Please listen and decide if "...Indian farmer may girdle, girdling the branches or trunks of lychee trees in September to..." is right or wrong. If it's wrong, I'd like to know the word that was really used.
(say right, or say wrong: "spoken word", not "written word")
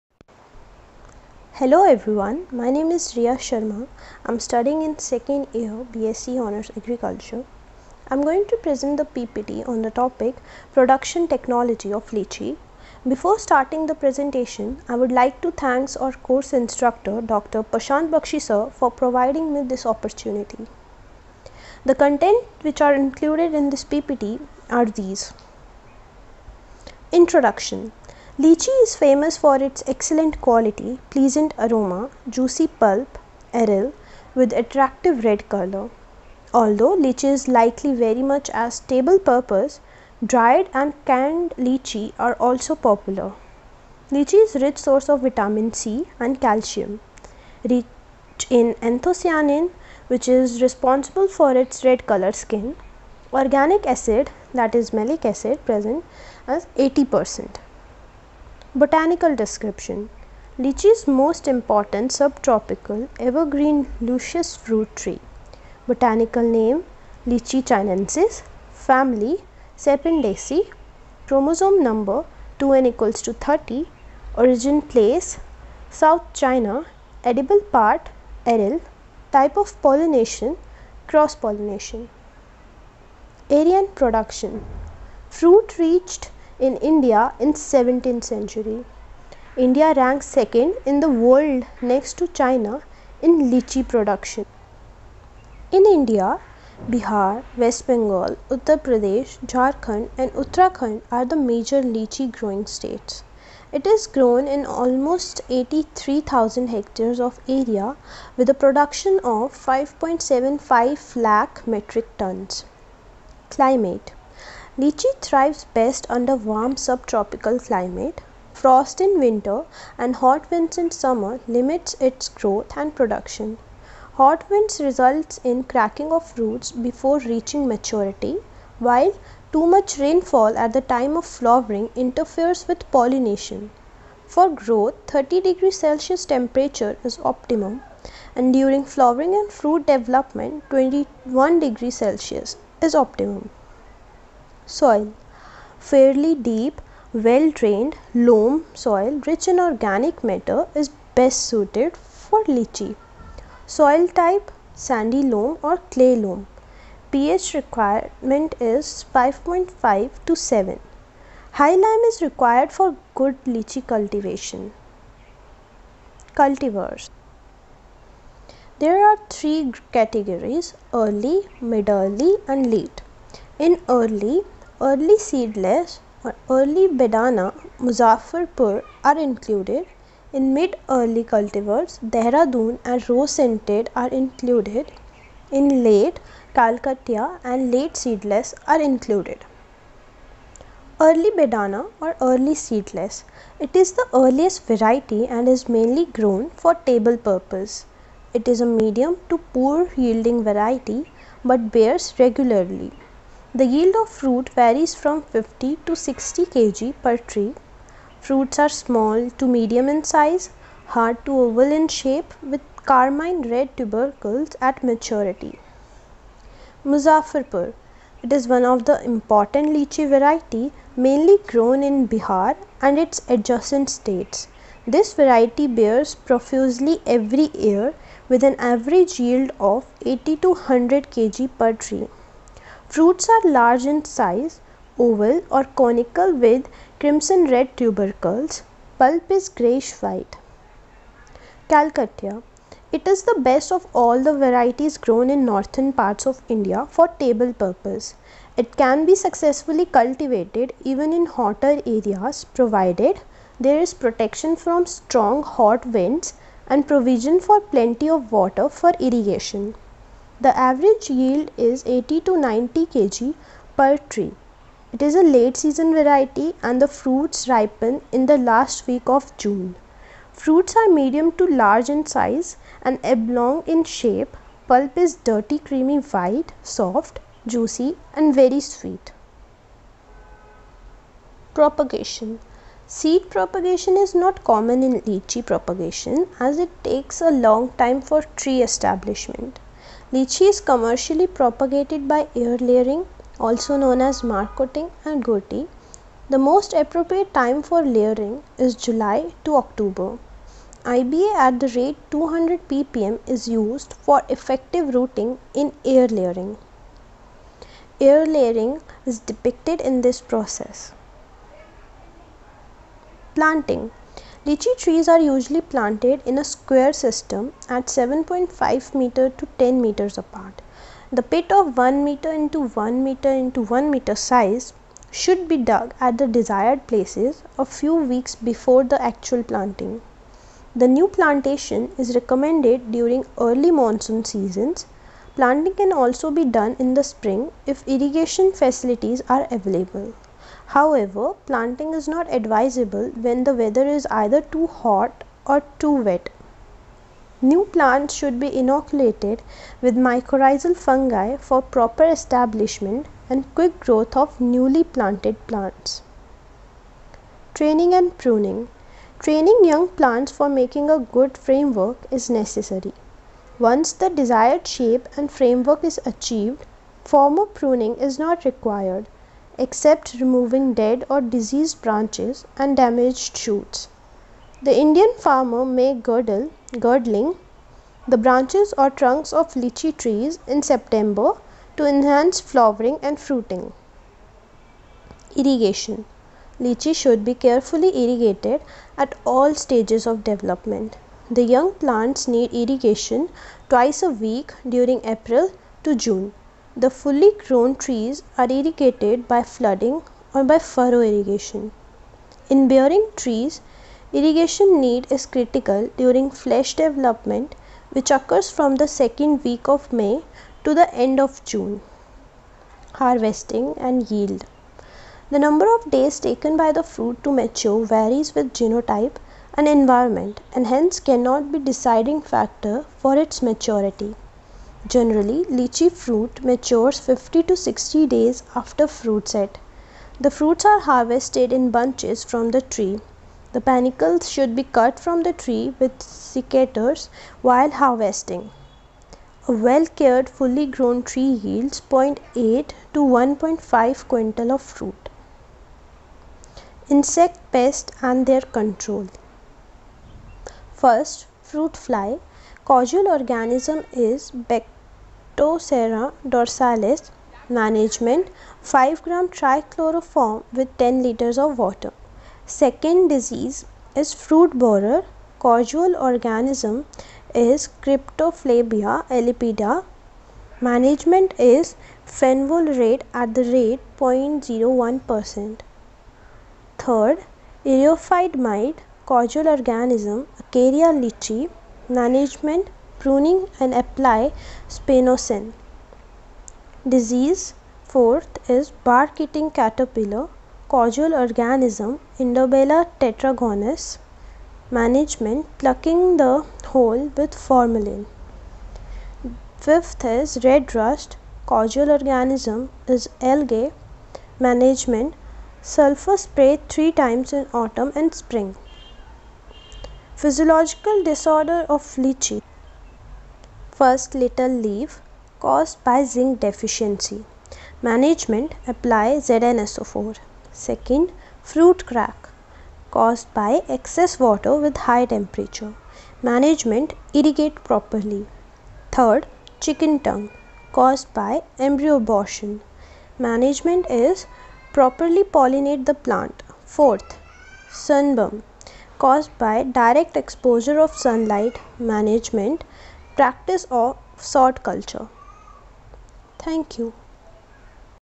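right.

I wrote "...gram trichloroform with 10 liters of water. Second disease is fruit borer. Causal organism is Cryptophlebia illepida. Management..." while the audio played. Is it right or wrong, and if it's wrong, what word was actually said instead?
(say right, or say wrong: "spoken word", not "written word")
right.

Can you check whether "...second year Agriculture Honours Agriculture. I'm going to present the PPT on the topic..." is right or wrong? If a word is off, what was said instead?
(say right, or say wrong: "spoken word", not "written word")
wrong: "BSc", not "Agriculture".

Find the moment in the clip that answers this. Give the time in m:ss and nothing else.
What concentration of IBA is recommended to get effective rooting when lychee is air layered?
5:02.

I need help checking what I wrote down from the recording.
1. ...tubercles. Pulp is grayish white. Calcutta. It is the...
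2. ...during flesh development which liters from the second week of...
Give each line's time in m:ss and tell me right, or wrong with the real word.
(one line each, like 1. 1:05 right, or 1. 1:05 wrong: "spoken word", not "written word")
1. 3:57 right
2. 6:45 wrong: "occurs", not "liters".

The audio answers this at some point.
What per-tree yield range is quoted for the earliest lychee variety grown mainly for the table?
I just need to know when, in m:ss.
3:25.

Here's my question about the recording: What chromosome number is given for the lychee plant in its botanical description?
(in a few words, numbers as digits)
2n = 30.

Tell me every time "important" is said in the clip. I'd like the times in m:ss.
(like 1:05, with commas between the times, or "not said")
1:01, 3:39.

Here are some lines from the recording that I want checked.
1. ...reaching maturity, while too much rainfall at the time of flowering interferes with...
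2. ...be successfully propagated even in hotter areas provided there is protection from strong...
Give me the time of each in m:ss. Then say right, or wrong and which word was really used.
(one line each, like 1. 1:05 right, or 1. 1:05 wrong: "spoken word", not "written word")
1. 2:07 right
2. 4:09 wrong: "cultivated", not "propagated".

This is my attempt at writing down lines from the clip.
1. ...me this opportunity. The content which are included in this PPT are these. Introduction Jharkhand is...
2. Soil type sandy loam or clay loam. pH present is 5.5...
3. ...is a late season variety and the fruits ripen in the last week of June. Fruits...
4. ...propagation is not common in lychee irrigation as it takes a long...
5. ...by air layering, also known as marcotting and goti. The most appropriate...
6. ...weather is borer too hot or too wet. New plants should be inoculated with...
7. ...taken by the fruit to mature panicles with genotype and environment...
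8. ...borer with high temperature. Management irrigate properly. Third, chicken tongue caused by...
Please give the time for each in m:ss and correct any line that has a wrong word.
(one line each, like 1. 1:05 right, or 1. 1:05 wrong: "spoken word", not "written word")
1. 0:19 wrong: "Lychee", not "Jharkhand"
2. 2:33 wrong: "requirement", not "present"
3. 4:25 right
4. 4:43 wrong: "propagation", not "irrigation"
5. 4:52 right
6. 5:43 wrong: "either", not "borer"
7. 6:56 wrong: "varies", not "panicles"
8. 8:44 wrong: "water", not "borer".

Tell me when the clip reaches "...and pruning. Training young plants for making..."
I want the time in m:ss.
5:57.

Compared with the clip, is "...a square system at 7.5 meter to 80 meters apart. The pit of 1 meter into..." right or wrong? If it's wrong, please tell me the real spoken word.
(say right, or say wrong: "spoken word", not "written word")
wrong: "10", not "80".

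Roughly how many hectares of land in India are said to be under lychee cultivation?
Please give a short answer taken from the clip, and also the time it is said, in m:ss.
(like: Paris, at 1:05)
83,000 hectares, at 1:45.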